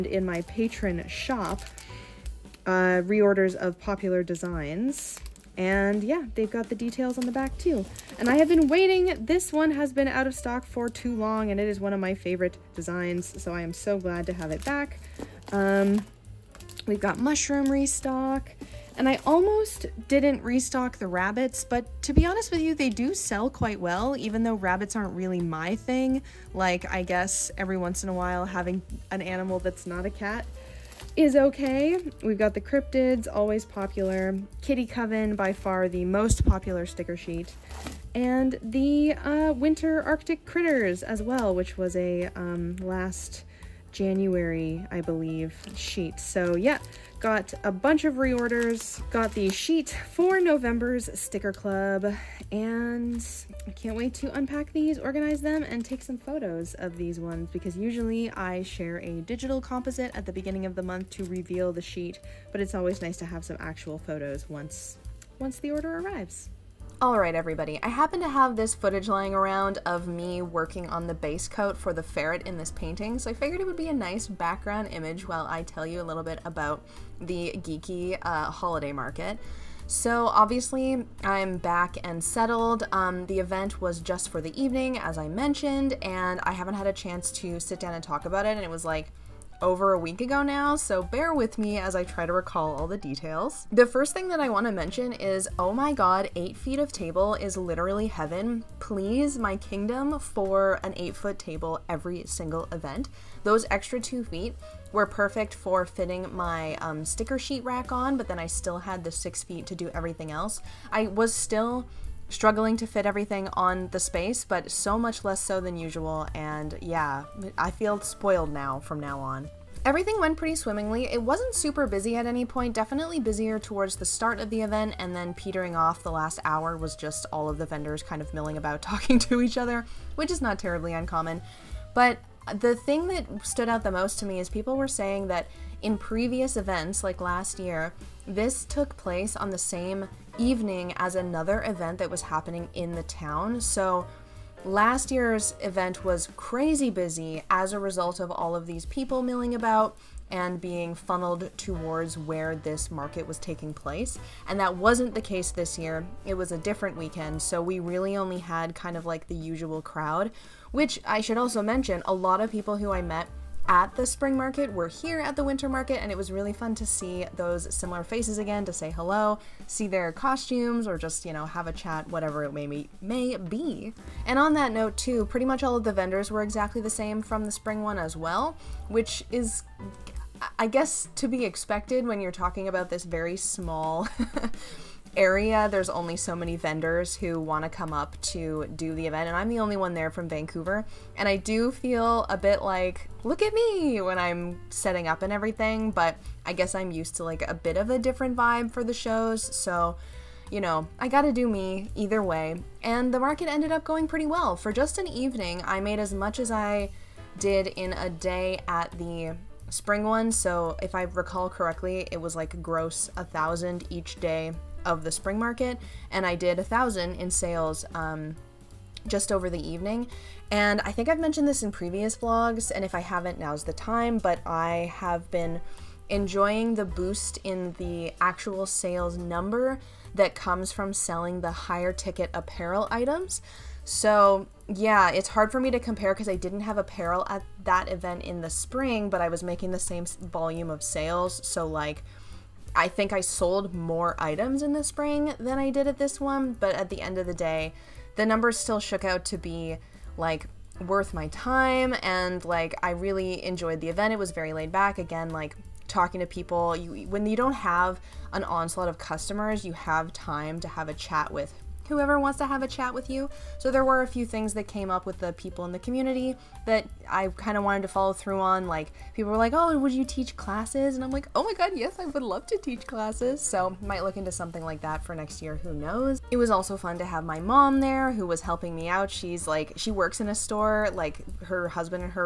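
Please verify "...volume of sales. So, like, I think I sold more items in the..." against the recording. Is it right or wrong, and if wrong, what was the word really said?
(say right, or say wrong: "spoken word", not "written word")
right.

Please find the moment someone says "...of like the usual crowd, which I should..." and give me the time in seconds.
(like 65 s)
158 s.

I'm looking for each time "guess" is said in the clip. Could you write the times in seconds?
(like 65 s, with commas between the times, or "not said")
27 s, 180 s, 196 s.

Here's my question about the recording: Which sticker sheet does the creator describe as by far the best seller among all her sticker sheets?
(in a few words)
Kitty Coven.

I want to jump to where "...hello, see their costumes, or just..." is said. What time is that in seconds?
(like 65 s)
168 s.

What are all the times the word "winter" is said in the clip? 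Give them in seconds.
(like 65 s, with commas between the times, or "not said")
39 s, 165 s.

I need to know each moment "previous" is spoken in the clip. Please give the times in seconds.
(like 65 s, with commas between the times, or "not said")
135 s, 221 s.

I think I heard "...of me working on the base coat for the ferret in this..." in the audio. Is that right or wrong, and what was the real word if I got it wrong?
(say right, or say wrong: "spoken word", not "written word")
right.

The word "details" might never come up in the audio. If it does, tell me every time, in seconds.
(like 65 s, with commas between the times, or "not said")
6 s, 92 s.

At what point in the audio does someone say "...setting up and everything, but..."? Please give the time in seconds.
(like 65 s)
194 s.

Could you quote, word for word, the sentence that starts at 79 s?
So obviously I'm back and settled.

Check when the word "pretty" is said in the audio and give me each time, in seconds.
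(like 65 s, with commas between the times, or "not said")
120 s, 175 s, 204 s.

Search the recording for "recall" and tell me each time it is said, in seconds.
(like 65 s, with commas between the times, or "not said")
92 s, 211 s.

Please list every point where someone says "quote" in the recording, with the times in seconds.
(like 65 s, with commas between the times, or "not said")
not said.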